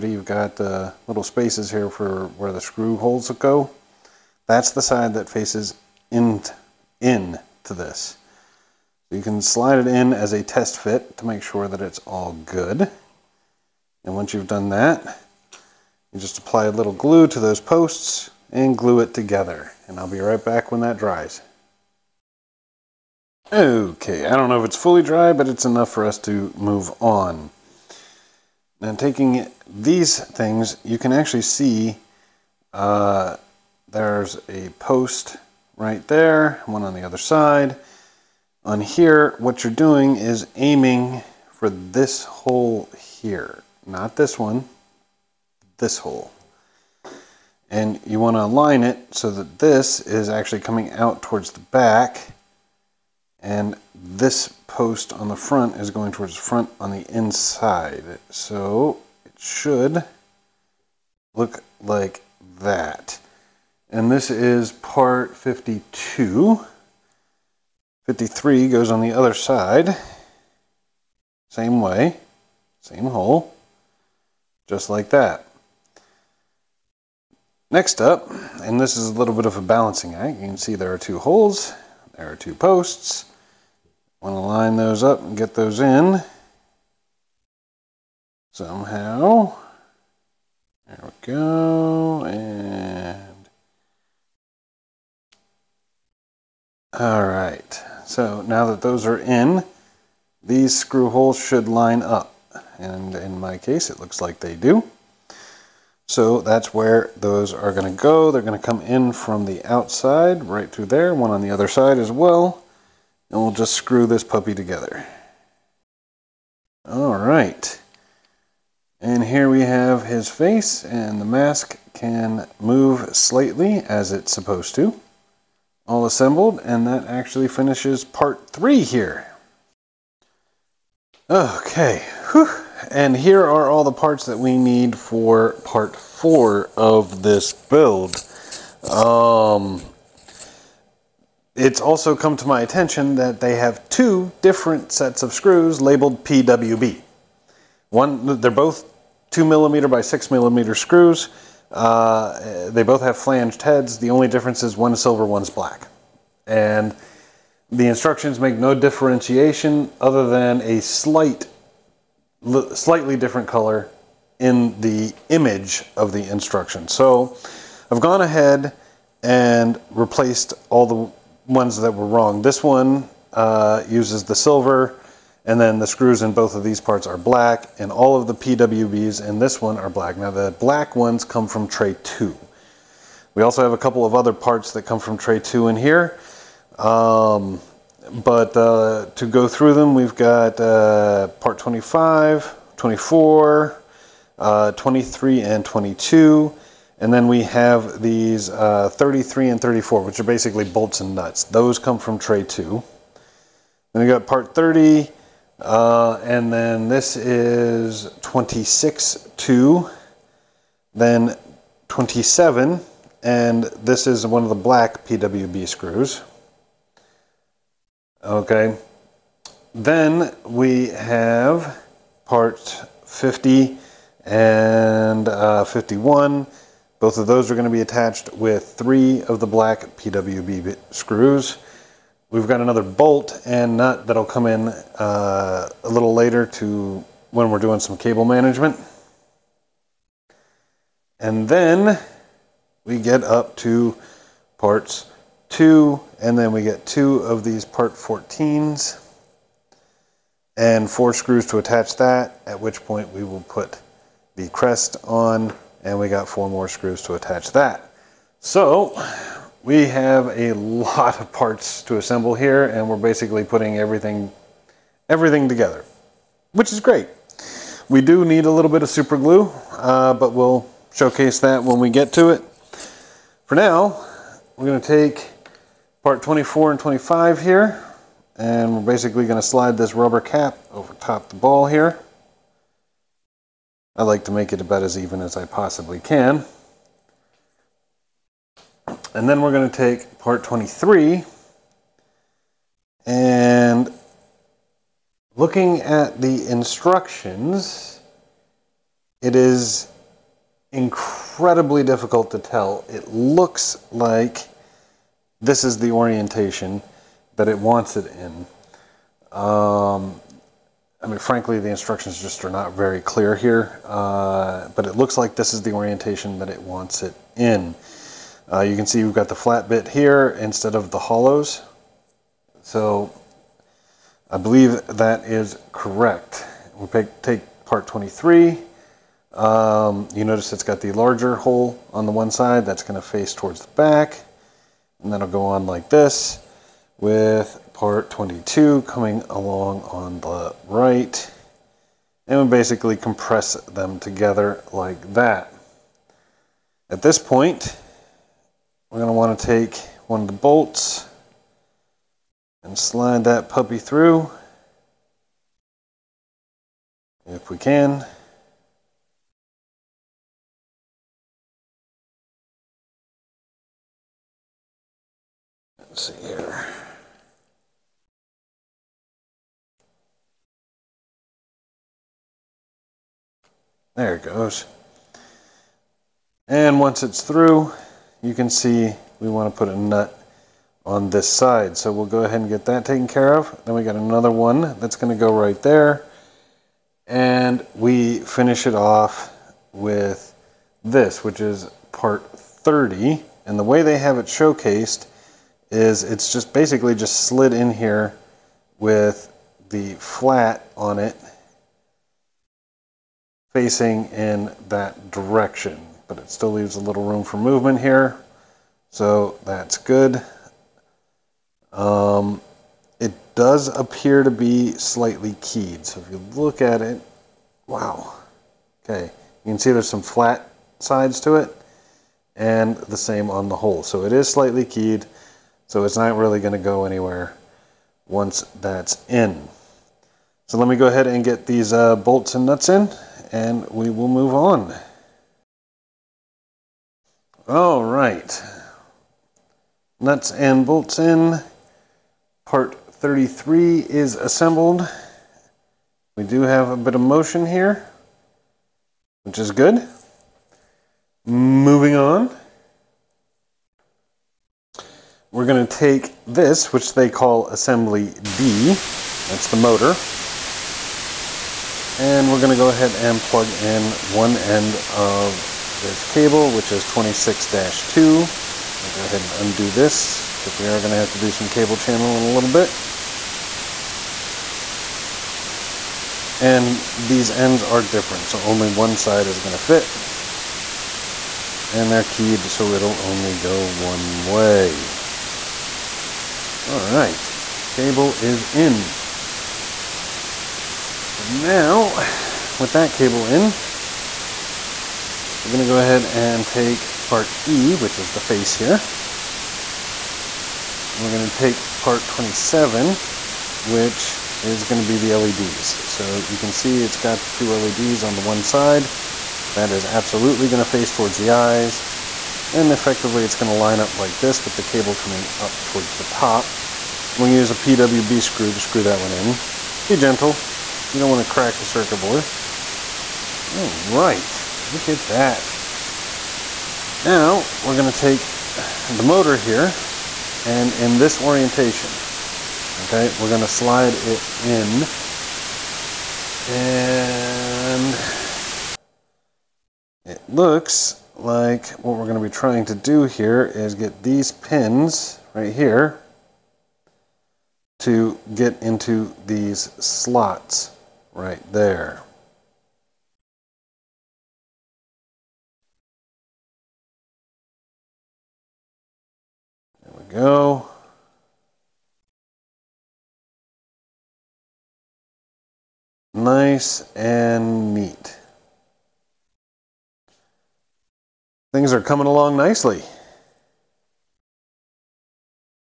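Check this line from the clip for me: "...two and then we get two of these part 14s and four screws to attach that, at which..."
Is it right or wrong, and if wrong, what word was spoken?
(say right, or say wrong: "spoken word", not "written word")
right.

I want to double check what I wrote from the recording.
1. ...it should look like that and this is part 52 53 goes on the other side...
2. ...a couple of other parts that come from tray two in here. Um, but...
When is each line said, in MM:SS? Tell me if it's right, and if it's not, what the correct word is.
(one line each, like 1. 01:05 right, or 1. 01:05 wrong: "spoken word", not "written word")
1. 00:59 right
2. 03:03 right.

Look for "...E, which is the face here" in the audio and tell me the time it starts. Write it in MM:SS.
08:17.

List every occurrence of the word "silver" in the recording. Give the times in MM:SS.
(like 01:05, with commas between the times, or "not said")
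02:35, 02:54.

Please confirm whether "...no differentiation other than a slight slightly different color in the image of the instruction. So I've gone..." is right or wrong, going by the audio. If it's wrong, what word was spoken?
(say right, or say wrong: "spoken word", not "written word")
right.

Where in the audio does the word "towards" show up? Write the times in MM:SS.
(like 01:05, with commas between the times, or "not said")
00:51, 00:56, 05:33, 08:30, 08:35.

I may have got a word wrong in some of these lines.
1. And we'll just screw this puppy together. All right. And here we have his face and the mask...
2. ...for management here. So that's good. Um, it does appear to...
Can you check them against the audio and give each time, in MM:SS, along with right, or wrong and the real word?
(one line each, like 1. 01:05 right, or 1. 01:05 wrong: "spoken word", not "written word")
1. 01:53 right
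2. 06:47 wrong: "movement", not "management".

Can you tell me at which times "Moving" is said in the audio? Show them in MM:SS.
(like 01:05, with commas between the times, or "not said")
07:31.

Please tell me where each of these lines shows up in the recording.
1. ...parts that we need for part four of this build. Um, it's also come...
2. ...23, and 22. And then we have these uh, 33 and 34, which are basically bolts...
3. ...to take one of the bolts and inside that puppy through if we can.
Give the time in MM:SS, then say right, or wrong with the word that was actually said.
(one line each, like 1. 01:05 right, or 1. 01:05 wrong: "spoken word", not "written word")
1. 02:13 right
2. 03:14 right
3. 05:49 wrong: "slide", not "inside".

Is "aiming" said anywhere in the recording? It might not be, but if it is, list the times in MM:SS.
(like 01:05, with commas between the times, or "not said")
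00:40.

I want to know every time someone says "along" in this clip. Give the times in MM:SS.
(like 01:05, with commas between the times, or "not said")
05:39, 09:32.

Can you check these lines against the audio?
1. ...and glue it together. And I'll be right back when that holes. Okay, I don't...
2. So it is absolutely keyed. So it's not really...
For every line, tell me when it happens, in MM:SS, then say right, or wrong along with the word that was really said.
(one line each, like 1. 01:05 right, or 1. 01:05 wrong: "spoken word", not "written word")
1. 00:18 wrong: "dries", not "holes"
2. 07:03 wrong: "slightly", not "absolutely".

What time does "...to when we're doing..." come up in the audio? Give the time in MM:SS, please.
03:56.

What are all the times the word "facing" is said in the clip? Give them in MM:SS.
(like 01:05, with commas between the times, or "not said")
06:43.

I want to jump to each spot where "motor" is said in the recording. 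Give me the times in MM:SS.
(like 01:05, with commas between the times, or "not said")
07:39, 08:49.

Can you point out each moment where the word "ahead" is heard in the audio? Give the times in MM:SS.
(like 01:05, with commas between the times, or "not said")
02:48, 06:22, 07:10, 07:42, 07:49, 08:15.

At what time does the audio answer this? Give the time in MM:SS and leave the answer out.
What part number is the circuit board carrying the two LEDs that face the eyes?
08:21.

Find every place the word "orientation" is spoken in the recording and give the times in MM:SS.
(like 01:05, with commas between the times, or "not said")
05:05, 05:15, 08:51.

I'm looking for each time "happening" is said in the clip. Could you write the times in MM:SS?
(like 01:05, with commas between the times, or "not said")
not said.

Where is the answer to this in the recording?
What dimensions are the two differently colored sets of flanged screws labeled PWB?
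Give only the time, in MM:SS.
02:29.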